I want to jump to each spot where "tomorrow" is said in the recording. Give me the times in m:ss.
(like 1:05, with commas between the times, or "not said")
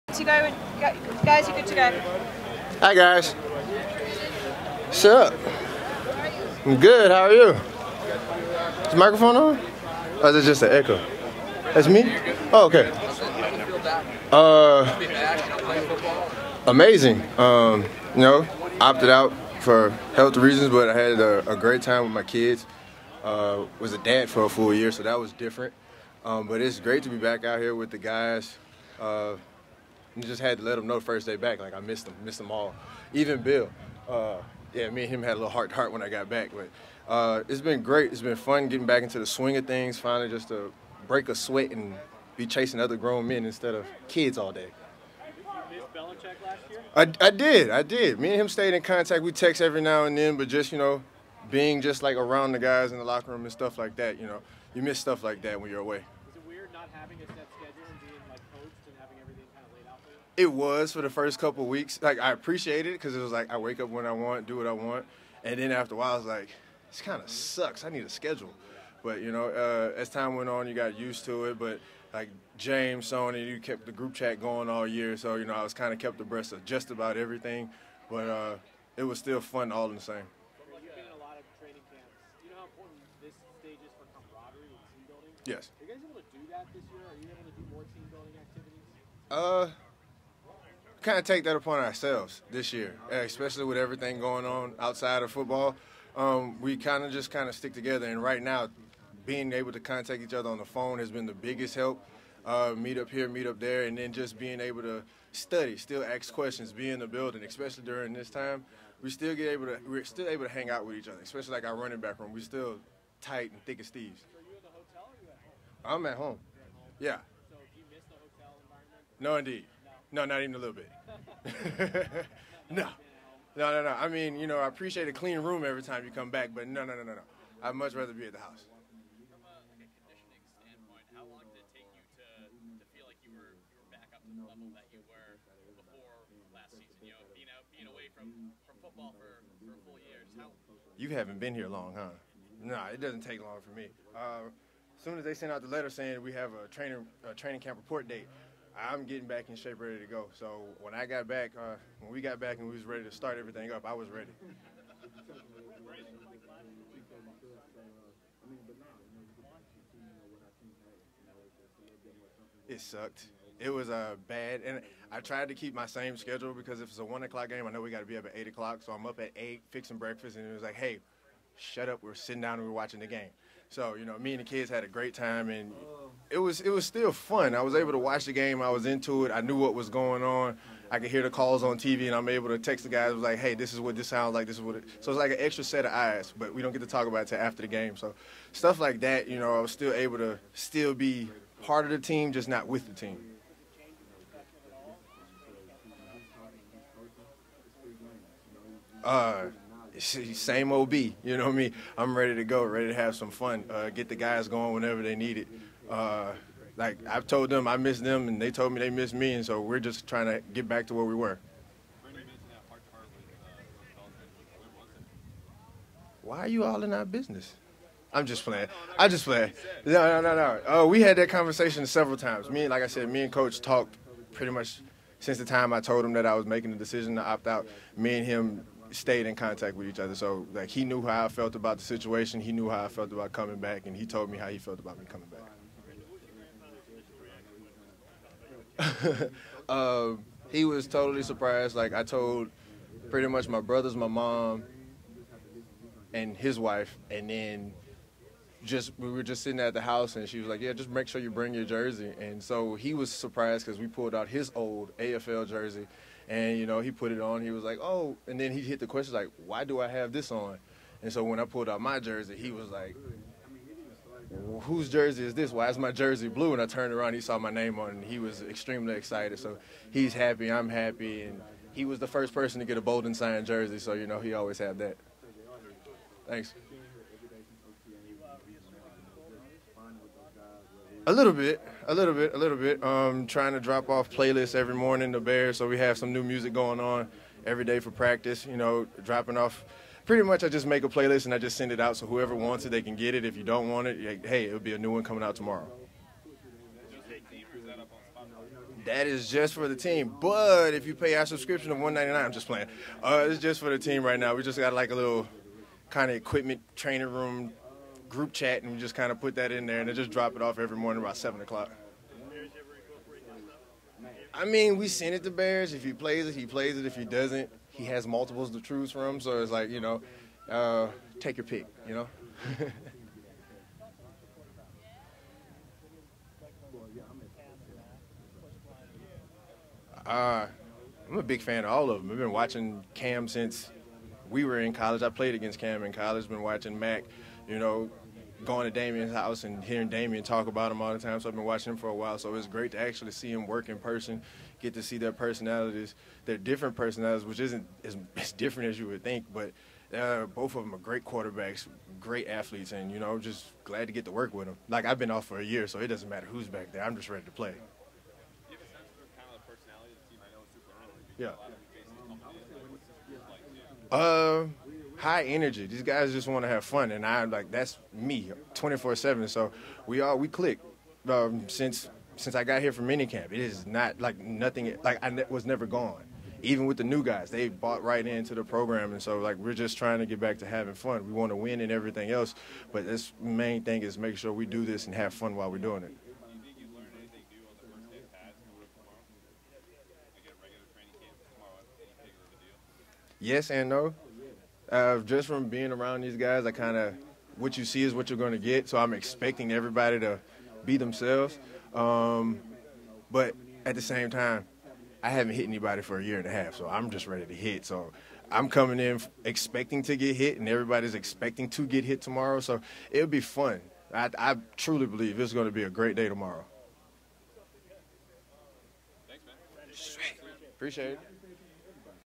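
4:55, 6:52, 6:56.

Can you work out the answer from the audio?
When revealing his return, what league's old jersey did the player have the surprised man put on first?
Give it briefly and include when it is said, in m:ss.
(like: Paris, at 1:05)
AFL, at 4:14.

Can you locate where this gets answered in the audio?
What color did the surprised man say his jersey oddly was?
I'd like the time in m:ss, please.
4:26.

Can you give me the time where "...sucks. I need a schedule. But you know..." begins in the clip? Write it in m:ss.
1:07.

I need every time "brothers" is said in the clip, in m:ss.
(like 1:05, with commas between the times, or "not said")
4:03.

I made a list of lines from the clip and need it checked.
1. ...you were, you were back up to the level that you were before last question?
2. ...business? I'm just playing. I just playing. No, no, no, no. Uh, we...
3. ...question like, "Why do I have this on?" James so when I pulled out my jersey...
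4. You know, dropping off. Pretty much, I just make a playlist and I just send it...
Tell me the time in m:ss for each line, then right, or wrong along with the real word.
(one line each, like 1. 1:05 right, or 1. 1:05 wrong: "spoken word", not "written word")
1. 2:13 wrong: "season", not "question"
2. 3:37 right
3. 4:18 wrong: "And", not "James"
4. 4:48 right.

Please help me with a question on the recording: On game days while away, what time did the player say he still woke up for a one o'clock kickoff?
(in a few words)
8:00.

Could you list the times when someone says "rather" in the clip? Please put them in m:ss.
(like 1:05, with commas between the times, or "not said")
2:07.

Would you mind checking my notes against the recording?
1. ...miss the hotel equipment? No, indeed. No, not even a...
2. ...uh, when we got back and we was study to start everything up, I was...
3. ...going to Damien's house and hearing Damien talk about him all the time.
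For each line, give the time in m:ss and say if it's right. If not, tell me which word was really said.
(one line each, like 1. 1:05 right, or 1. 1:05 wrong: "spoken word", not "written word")
1. 1:57 wrong: "environment", not "equipment"
2. 2:31 wrong: "ready", not "study"
3. 5:38 right.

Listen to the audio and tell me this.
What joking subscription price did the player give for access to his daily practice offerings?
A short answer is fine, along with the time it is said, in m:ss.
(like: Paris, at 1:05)
199, at 5:01.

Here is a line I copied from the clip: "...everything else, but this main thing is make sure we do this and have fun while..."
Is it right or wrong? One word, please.
right.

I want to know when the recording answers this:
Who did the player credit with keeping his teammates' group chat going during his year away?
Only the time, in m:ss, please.
1:12.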